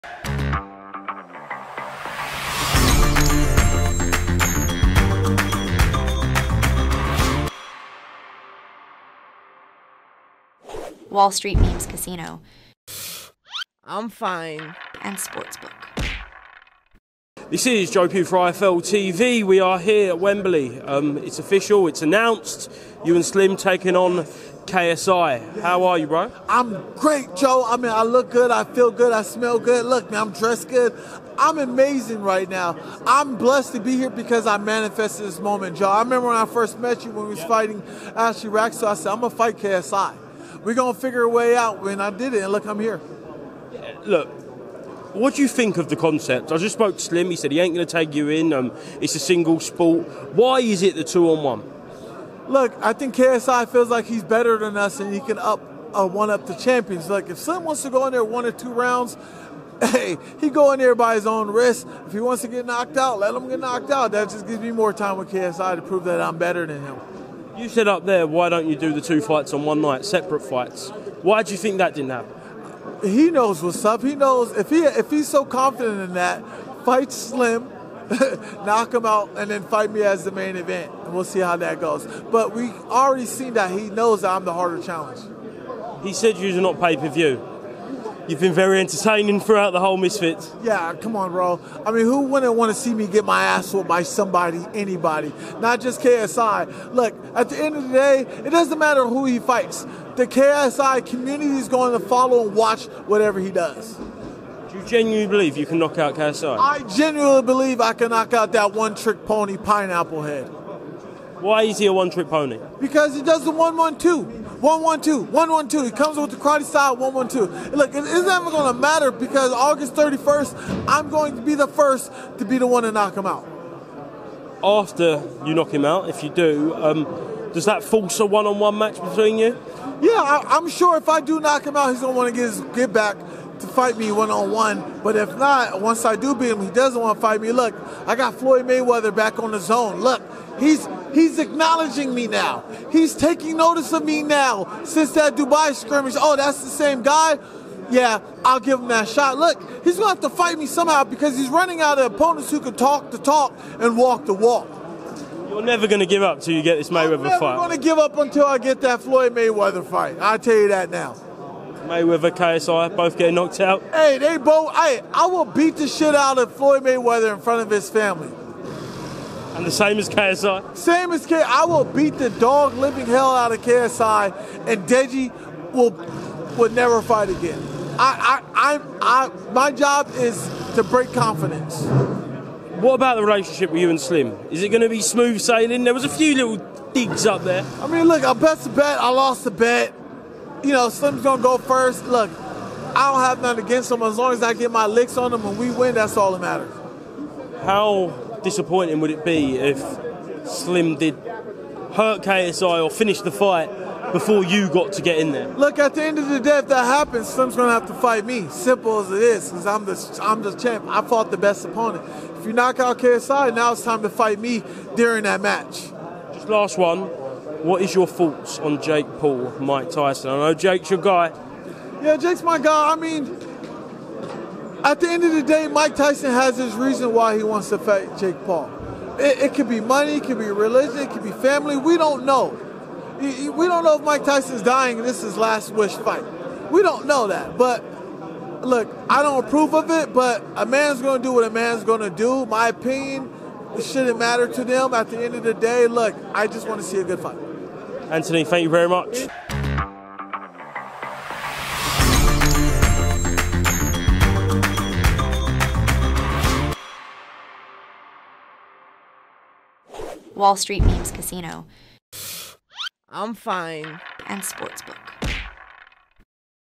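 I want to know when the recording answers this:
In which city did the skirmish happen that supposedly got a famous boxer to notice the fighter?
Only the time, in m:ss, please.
2:25.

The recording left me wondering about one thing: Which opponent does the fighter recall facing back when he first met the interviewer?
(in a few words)
Ashley Rack.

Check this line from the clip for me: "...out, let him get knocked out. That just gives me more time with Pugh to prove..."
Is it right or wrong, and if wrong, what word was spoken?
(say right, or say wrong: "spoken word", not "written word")
wrong: "KSI", not "Pugh".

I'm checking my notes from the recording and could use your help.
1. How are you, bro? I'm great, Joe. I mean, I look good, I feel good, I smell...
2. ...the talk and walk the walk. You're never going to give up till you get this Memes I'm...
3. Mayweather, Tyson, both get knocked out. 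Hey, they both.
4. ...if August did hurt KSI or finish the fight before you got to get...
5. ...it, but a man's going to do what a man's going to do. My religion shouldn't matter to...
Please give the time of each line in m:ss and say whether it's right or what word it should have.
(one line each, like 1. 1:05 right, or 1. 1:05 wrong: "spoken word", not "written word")
1. 0:25 right
2. 2:33 wrong: "Mayweather", not "Memes"
3. 2:41 wrong: "KSI", not "Tyson"
4. 3:19 wrong: "Slim", not "August"
5. 3:59 wrong: "opinion", not "religion".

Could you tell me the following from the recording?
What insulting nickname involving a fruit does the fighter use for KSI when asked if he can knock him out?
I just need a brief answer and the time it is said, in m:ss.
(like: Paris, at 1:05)
pineapple head, at 1:49.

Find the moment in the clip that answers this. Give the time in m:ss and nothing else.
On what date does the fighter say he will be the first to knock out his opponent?
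1:59.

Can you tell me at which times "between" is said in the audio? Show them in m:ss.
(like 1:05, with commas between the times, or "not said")
2:09.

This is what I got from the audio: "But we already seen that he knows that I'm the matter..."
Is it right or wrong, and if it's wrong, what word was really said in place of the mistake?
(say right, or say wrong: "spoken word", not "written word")
wrong: "harder", not "matter".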